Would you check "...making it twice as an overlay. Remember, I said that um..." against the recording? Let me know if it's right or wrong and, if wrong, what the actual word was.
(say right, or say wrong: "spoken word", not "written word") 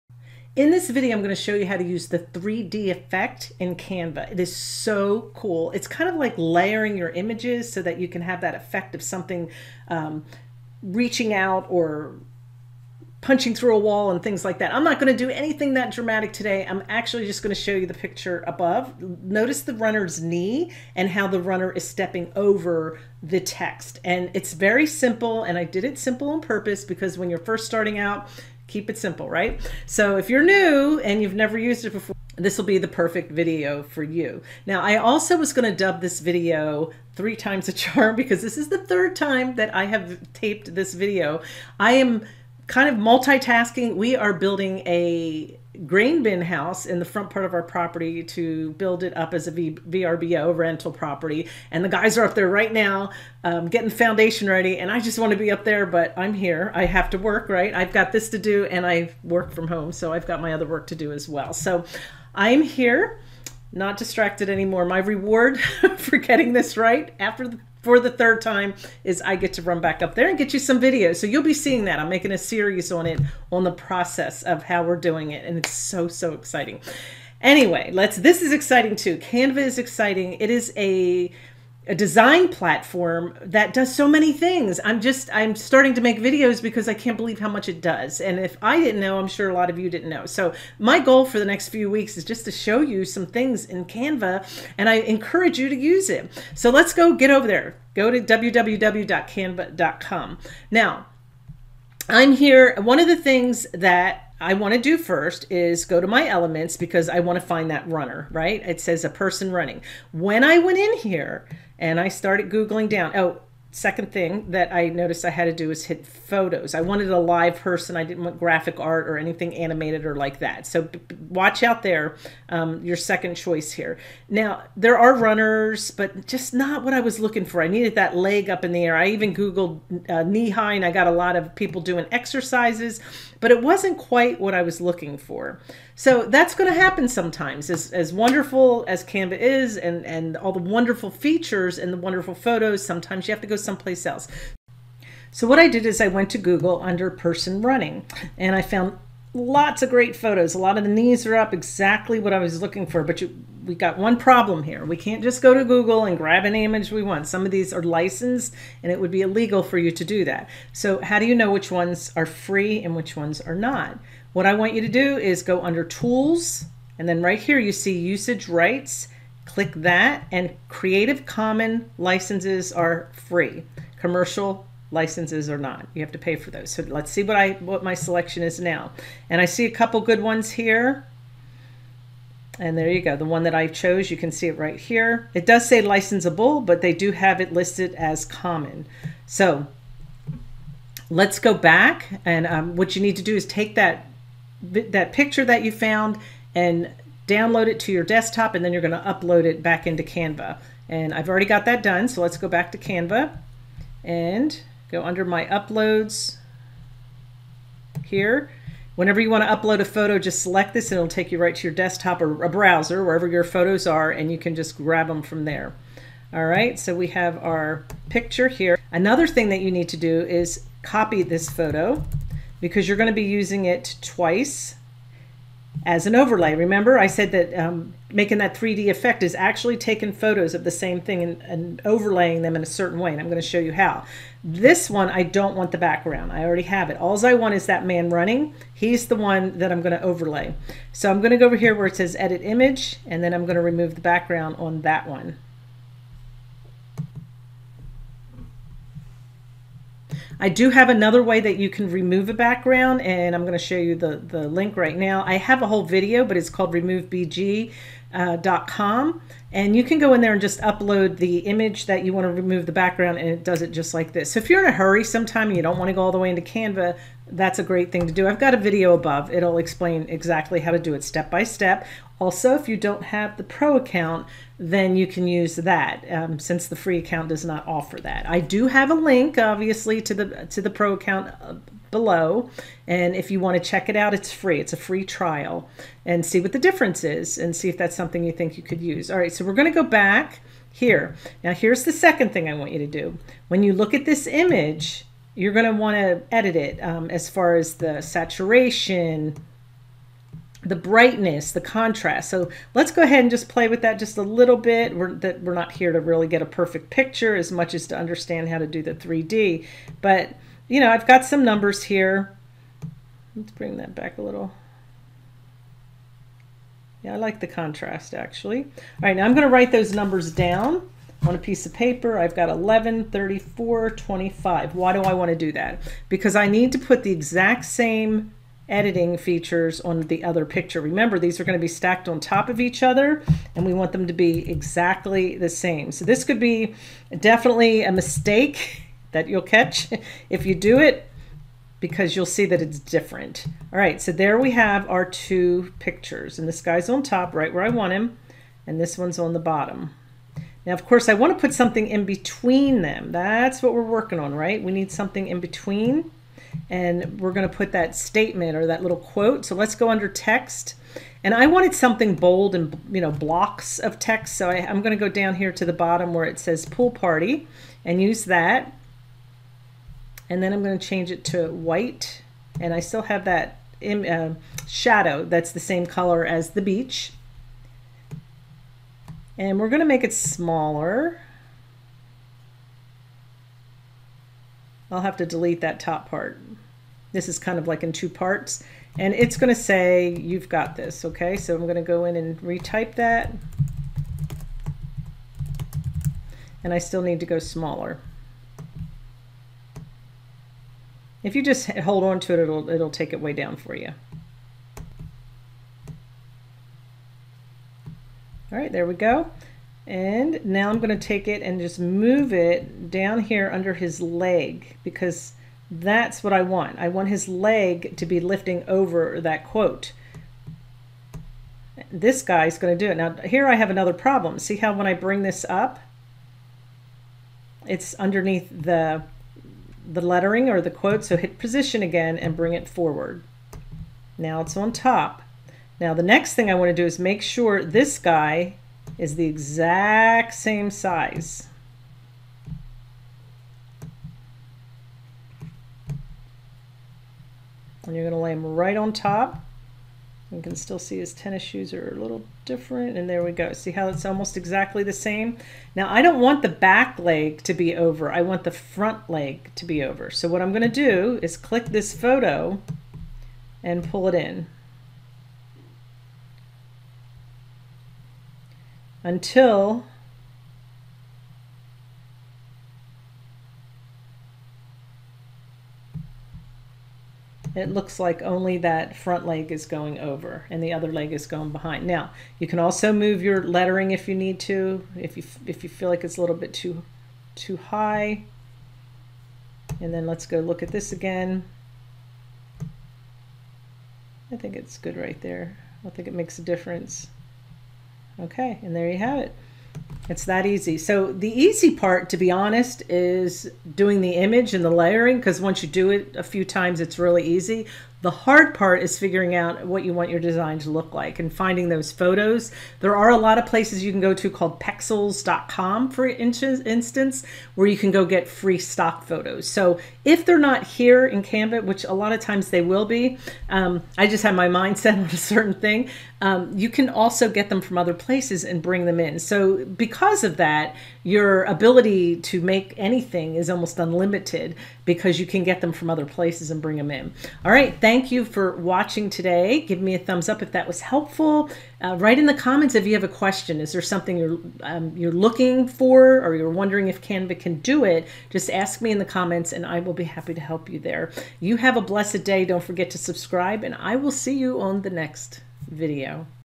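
wrong: "using", not "making".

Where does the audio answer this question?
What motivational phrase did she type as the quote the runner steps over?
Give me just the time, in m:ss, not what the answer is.
6:30.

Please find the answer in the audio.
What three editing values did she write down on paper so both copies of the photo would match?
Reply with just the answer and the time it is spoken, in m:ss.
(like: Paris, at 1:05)
11, 34, 25, at 5:22.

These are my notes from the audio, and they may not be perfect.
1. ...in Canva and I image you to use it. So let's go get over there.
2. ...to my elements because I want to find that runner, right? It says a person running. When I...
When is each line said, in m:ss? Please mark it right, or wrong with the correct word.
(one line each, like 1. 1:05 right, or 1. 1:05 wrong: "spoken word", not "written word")
1. 1:33 wrong: "encourage", not "image"
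2. 1:46 right.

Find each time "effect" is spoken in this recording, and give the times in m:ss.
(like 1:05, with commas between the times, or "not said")
0:02, 0:08, 3:48.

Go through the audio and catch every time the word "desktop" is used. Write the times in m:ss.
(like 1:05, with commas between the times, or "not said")
3:18, 3:31.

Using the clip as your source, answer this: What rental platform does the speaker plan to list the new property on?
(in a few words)
VRBO.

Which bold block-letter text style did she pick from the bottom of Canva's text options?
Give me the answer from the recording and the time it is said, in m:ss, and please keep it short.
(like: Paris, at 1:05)
Pool party, at 6:06.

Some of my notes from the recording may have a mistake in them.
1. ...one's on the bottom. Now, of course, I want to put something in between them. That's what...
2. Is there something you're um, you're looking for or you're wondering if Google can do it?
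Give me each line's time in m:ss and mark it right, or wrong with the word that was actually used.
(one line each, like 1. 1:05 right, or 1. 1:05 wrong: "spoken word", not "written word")
1. 5:48 right
2. 9:03 wrong: "Canva", not "Google".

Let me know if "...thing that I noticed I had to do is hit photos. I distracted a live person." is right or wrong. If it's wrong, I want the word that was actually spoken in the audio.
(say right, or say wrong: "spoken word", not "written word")
wrong: "wanted", not "distracted".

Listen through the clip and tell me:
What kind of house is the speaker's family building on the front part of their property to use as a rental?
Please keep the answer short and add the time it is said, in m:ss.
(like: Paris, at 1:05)
Grain bin house, at 0:45.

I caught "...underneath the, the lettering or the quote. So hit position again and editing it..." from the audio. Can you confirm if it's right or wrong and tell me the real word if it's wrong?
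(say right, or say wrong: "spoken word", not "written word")
wrong: "bring", not "editing".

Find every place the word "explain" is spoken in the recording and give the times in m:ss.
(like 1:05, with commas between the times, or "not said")
4:29.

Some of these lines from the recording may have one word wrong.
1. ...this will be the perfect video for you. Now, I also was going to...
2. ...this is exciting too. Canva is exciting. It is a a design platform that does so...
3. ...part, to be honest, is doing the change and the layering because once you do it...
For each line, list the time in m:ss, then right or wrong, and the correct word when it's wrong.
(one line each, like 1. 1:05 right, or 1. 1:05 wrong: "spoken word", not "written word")
1. 0:32 right
2. 1:18 right
3. 8:21 wrong: "image", not "change".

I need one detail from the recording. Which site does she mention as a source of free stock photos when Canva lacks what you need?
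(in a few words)
pexels.com.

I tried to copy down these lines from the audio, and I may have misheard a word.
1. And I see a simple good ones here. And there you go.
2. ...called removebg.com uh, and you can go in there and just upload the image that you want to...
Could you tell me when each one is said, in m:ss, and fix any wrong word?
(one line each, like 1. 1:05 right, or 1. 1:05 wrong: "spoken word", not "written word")
1. 2:59 wrong: "couple", not "simple"
2. 4:16 right.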